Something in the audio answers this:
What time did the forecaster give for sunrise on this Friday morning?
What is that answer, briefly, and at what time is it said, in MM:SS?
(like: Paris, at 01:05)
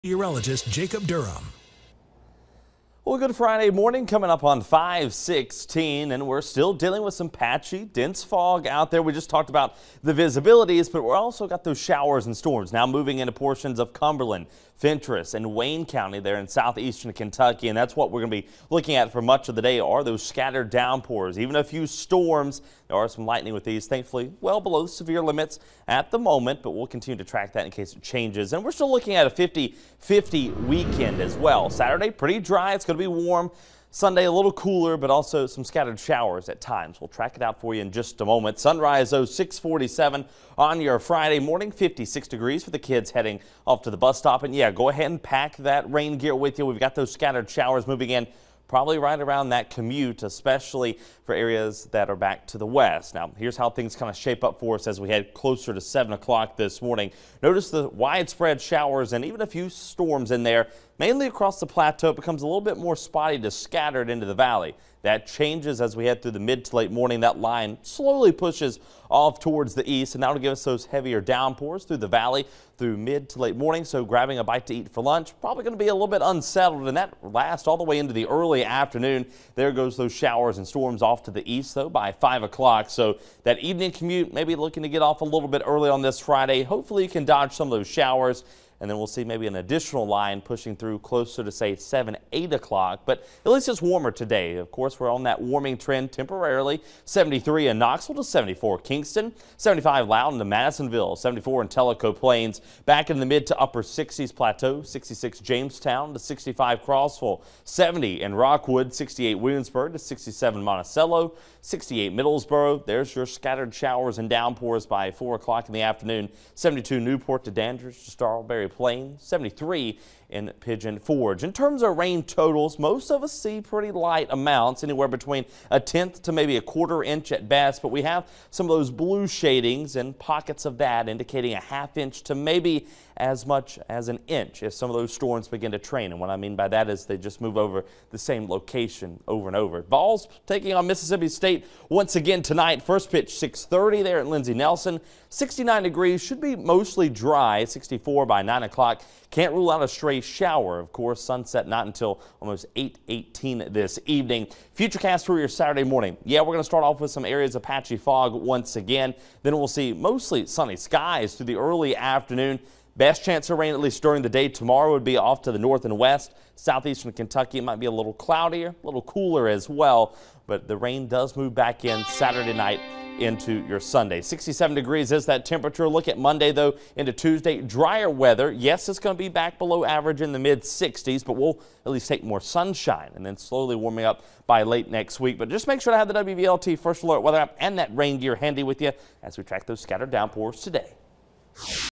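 6:47, at 00:39.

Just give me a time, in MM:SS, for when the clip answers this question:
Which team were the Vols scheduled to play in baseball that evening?
02:20.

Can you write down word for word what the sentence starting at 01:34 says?
Of course, we're on that warming trend temporarily.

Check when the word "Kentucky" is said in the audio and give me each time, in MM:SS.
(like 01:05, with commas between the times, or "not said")
00:17, 02:47.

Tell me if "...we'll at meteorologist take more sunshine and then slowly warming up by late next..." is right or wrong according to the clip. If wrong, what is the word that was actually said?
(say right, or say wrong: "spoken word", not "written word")
wrong: "least", not "meteorologist".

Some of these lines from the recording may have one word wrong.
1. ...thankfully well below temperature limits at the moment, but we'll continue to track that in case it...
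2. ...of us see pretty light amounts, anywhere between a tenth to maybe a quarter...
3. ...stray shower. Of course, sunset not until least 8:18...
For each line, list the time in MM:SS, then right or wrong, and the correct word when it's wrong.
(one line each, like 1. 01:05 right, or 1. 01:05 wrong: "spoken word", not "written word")
1. 00:23 wrong: "severe", not "temperature"
2. 02:03 right
3. 02:29 wrong: "almost", not "least".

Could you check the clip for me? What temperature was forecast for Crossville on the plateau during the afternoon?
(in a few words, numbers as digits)
65.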